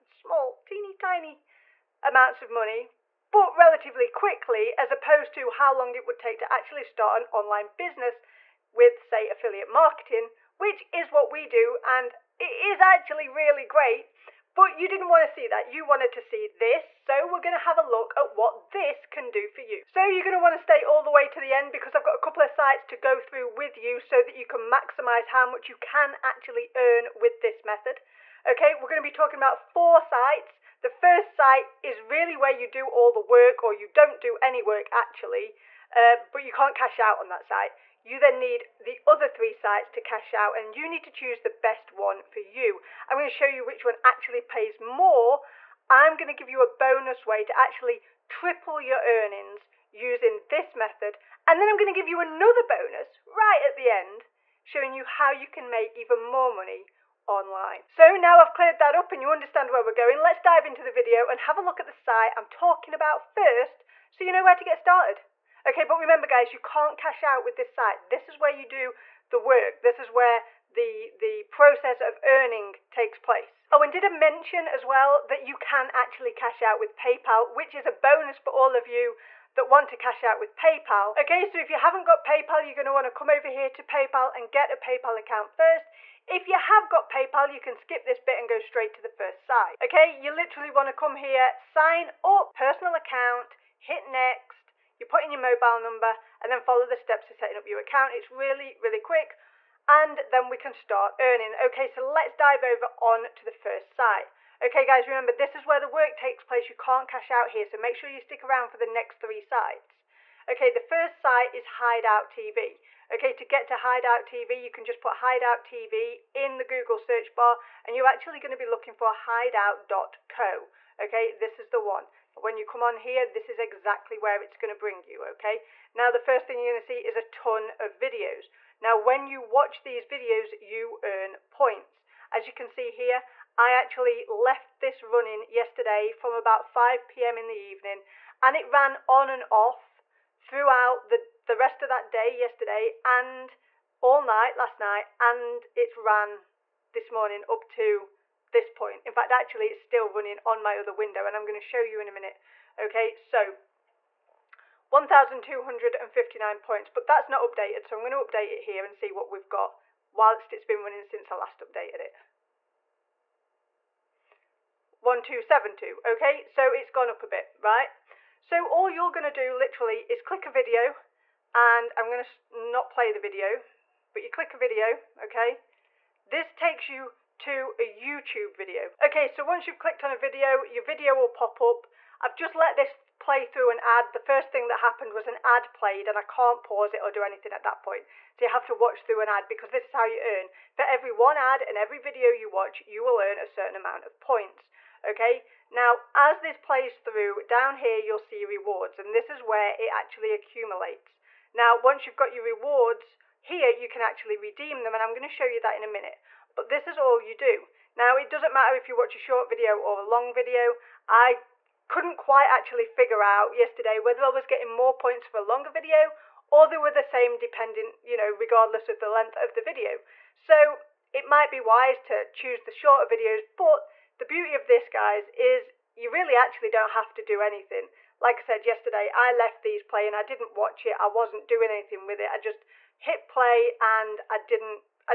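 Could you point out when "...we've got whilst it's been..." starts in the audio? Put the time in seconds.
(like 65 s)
159 s.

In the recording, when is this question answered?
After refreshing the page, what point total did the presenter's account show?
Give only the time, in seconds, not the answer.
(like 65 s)
164 s.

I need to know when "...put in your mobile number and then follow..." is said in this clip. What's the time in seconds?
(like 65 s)
95 s.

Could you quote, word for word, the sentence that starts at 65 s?
Okay, but remember guys, you can't cash out with this site.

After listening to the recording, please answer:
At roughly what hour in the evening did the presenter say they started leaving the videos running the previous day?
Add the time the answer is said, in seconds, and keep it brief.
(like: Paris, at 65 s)
5 p.m., at 136 s.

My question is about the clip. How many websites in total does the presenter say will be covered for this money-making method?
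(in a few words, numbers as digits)
4.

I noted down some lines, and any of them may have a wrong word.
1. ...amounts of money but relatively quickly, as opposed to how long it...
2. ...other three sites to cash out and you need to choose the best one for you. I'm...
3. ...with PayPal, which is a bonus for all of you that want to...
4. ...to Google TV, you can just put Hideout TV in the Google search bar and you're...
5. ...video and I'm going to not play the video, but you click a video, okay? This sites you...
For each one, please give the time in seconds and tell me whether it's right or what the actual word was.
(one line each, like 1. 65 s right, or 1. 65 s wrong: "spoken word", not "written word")
1. 2 s right
2. 39 s right
3. 76 s right
4. 113 s wrong: "Hideout", not "Google"
5. 170 s wrong: "takes", not "sites".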